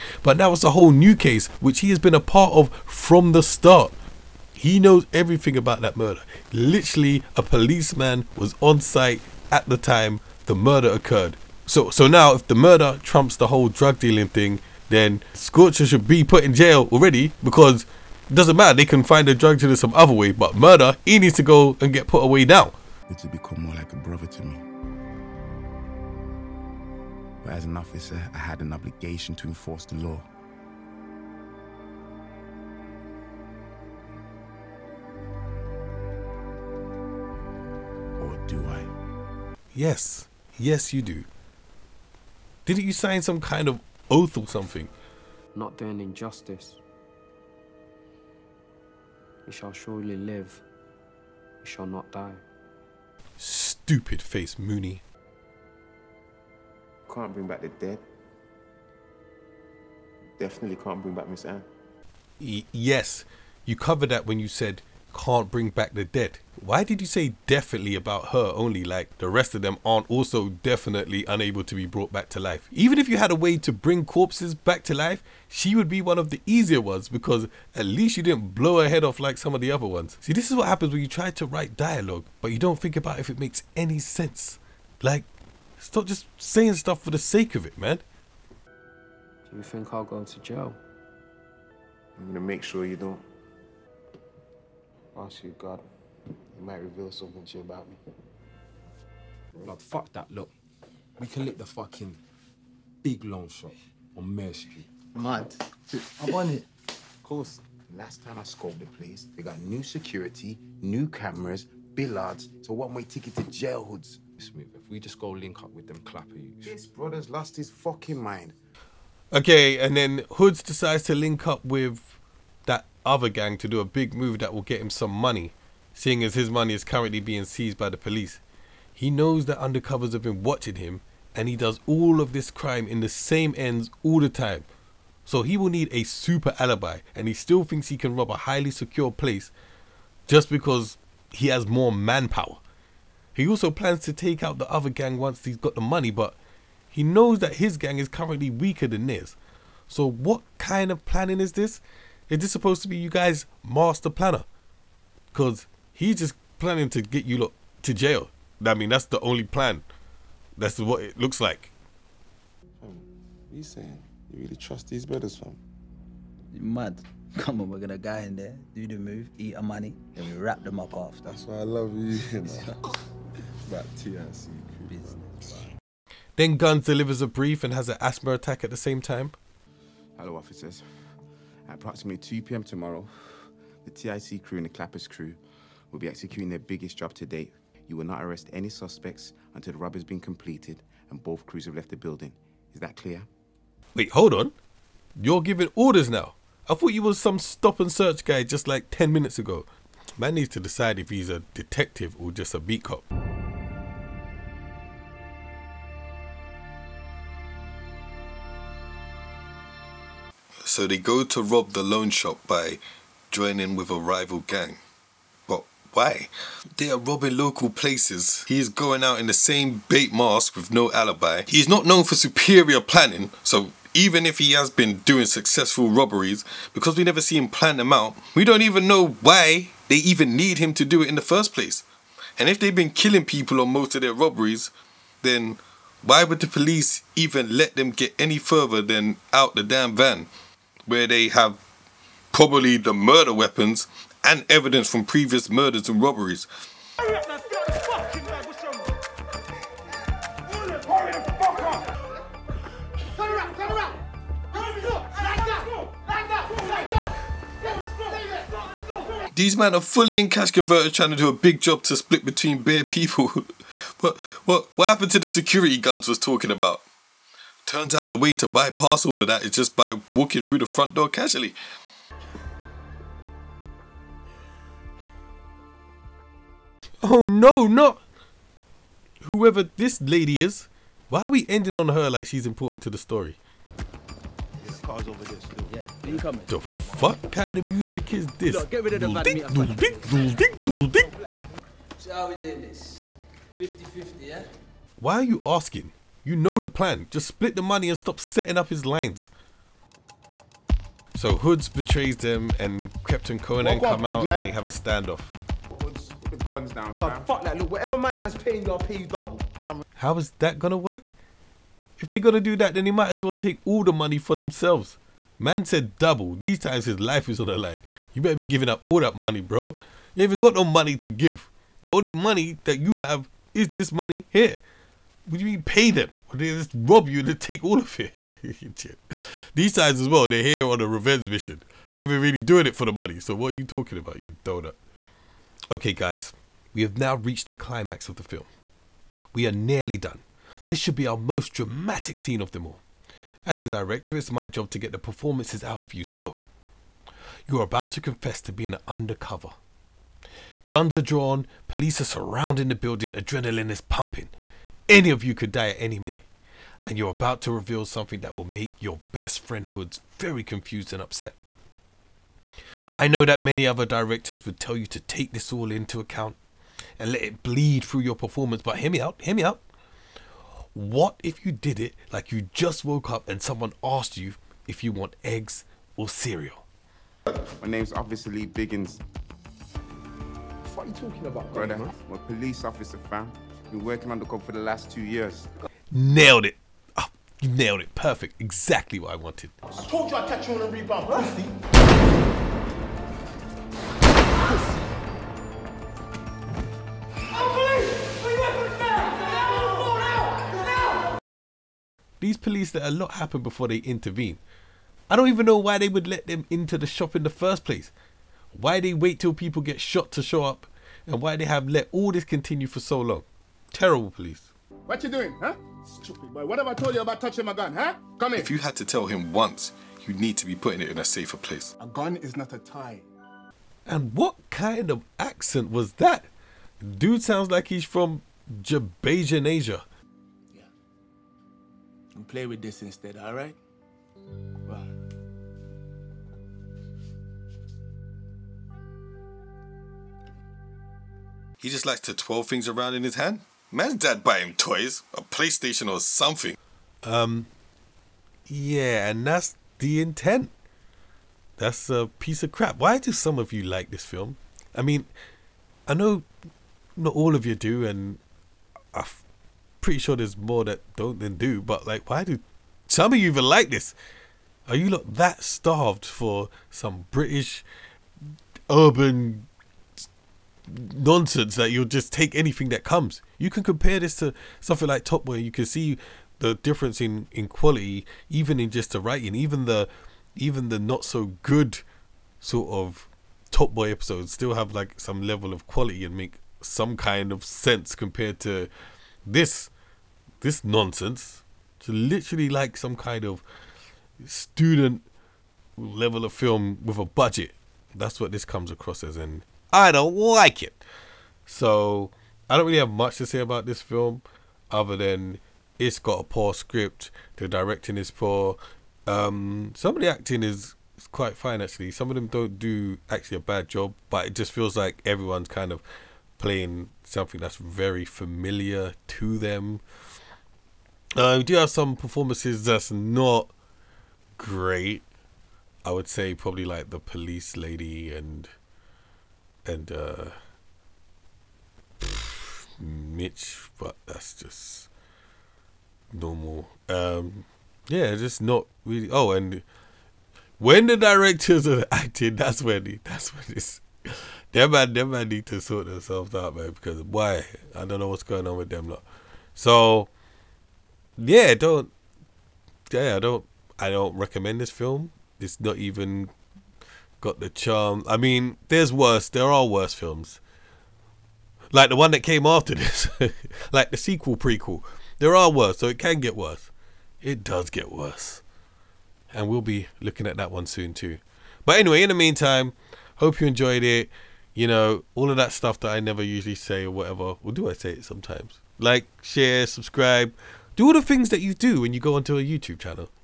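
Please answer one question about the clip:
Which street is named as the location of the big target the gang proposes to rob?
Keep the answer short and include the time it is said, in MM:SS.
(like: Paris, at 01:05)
Mare Street, at 01:44.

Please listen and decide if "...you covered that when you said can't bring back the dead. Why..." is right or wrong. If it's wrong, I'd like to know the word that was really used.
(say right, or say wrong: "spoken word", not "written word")
right.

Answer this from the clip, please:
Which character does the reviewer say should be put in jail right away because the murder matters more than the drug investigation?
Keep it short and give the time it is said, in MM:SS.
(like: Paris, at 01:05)
Scorcher, at 00:15.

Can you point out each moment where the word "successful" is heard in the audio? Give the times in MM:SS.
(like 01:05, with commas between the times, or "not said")
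03:45.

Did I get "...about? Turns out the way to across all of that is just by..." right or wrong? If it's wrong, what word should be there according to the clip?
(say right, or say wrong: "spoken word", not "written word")
wrong: "bypass", not "across".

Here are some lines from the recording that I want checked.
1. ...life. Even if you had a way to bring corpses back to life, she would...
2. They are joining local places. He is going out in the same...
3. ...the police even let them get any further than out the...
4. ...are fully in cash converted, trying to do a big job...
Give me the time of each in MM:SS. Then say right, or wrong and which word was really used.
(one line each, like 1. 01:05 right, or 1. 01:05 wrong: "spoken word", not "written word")
1. 01:12 right
2. 03:36 wrong: "robbing", not "joining"
3. 03:56 right
4. 04:19 right.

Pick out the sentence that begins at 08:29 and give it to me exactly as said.
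Um, some of the acting is quite fine actually.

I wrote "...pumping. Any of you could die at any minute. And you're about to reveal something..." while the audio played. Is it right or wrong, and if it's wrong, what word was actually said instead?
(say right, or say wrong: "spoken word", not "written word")
right.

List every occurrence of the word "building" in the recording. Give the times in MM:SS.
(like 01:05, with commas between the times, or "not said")
03:11, 05:52.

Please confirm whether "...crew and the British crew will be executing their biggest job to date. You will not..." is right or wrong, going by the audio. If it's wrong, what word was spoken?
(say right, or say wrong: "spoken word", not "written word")
wrong: "Clappers", not "British".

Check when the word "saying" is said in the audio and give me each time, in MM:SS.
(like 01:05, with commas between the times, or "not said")
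01:26, 02:43.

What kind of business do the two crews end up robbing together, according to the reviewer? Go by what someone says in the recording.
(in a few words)
loan shop.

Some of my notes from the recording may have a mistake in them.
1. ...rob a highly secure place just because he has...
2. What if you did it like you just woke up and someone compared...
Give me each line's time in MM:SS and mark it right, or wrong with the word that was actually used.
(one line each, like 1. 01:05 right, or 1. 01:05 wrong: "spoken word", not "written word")
1. 02:18 right
2. 06:10 wrong: "asked", not "compared".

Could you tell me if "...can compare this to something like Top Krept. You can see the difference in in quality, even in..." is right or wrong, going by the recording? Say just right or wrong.
wrong.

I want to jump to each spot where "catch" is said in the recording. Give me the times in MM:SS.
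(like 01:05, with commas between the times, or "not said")
06:30.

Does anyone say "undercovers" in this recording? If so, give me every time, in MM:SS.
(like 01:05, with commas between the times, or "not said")
02:09, 05:48.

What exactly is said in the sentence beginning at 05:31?
They ain't really doing it for the money.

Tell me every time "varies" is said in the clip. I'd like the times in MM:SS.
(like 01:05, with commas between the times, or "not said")
not said.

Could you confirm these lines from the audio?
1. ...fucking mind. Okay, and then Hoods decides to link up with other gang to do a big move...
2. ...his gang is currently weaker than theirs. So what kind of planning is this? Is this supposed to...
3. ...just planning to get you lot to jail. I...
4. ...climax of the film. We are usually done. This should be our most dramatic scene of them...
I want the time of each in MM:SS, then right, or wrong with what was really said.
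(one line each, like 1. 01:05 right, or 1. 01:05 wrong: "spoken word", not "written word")
1. 01:57 right
2. 02:27 right
3. 02:36 right
4. 05:37 wrong: "nearly", not "usually".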